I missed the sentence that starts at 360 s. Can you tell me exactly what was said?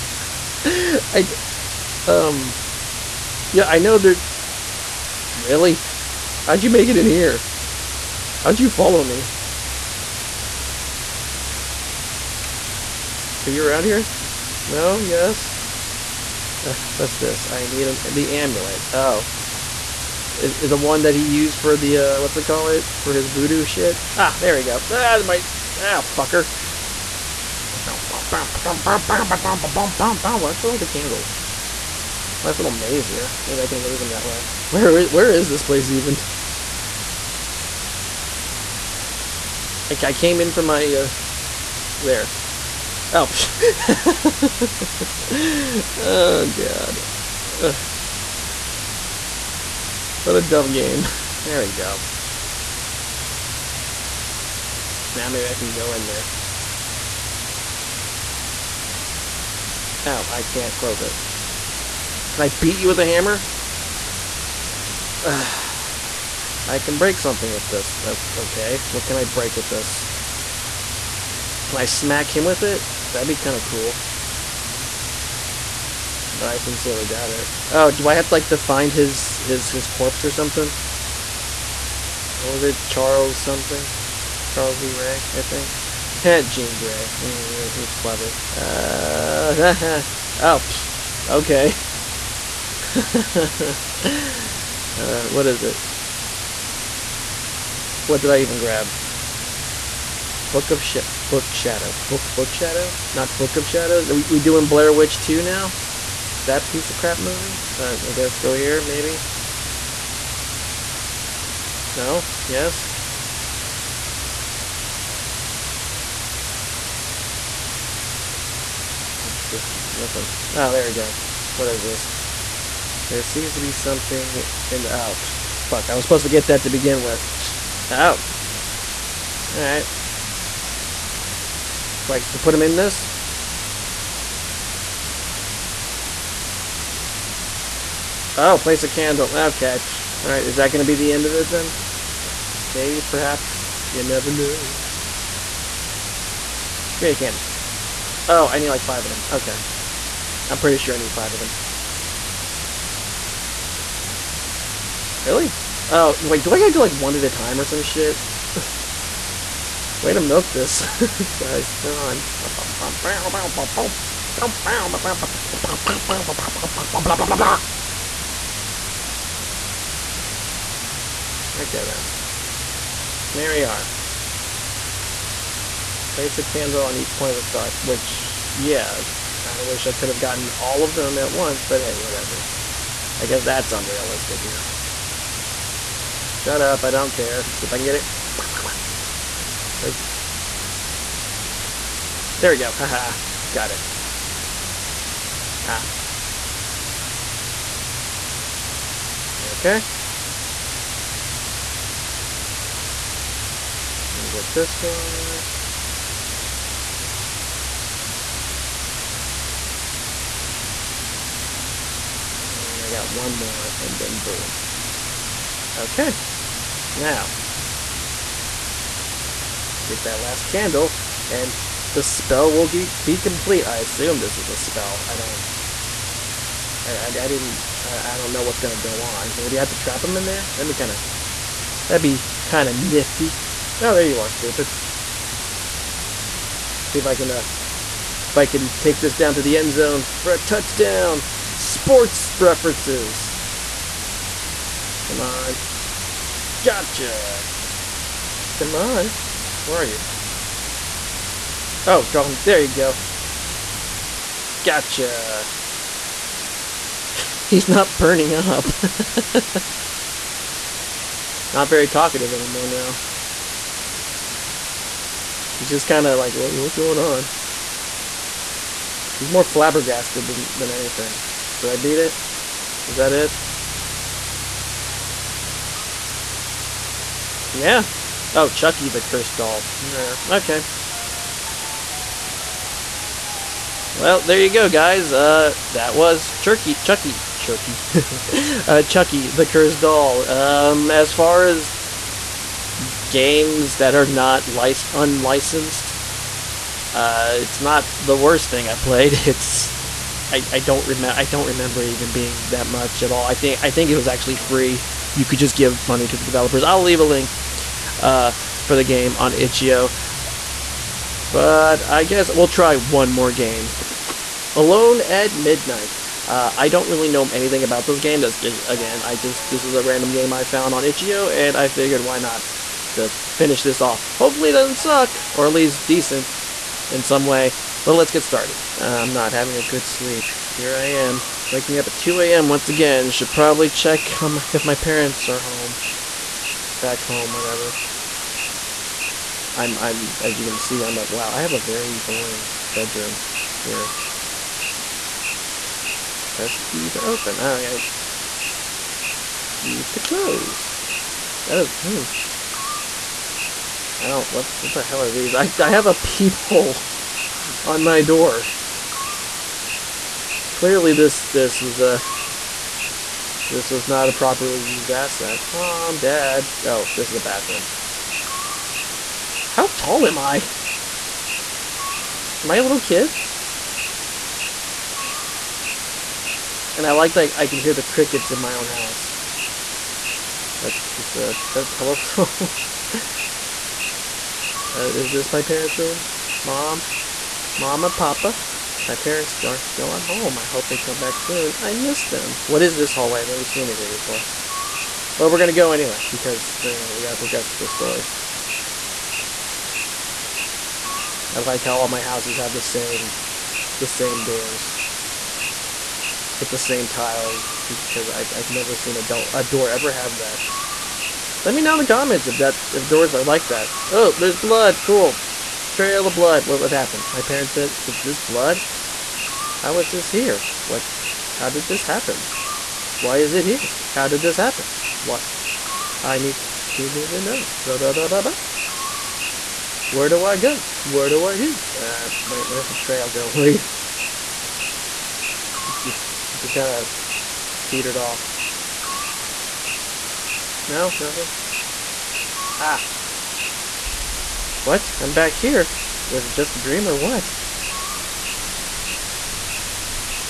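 Clearly this, this was a, this was not a properly used asset.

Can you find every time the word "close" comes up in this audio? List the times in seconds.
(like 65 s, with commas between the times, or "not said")
60 s, 349 s.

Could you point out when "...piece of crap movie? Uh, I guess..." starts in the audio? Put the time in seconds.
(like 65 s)
106 s.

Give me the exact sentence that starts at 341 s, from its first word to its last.
Wow, I have a very boring bedroom here.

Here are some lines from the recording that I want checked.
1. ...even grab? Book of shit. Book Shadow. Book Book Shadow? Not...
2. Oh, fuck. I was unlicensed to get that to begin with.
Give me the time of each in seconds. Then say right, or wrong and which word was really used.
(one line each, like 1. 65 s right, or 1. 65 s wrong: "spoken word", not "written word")
1. 98 s right
2. 124 s wrong: "supposed", not "unlicensed".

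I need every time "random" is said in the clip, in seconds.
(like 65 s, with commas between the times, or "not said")
319 s.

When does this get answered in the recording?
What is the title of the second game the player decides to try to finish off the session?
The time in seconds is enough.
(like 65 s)
314 s.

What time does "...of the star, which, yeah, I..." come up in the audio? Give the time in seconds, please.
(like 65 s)
177 s.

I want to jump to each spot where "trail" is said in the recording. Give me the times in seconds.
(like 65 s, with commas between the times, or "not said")
415 s, 432 s.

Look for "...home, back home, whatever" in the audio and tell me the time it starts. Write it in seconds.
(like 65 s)
335 s.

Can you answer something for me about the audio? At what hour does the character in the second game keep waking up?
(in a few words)
2 a.m.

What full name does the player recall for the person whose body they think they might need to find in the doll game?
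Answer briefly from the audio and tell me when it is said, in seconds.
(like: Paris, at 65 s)
Charles Lee Ray, at 84 s.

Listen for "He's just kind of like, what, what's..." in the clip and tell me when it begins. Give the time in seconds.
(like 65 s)
265 s.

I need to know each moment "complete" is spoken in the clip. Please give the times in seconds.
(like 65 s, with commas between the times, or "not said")
223 s.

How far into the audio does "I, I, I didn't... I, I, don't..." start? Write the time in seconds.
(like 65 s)
226 s.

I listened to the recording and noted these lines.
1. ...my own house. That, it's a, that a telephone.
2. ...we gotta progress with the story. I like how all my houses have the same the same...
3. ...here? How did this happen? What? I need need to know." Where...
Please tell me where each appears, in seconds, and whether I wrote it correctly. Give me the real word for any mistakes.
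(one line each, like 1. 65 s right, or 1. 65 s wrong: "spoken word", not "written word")
1. 378 s right
2. 396 s right
3. 423 s right.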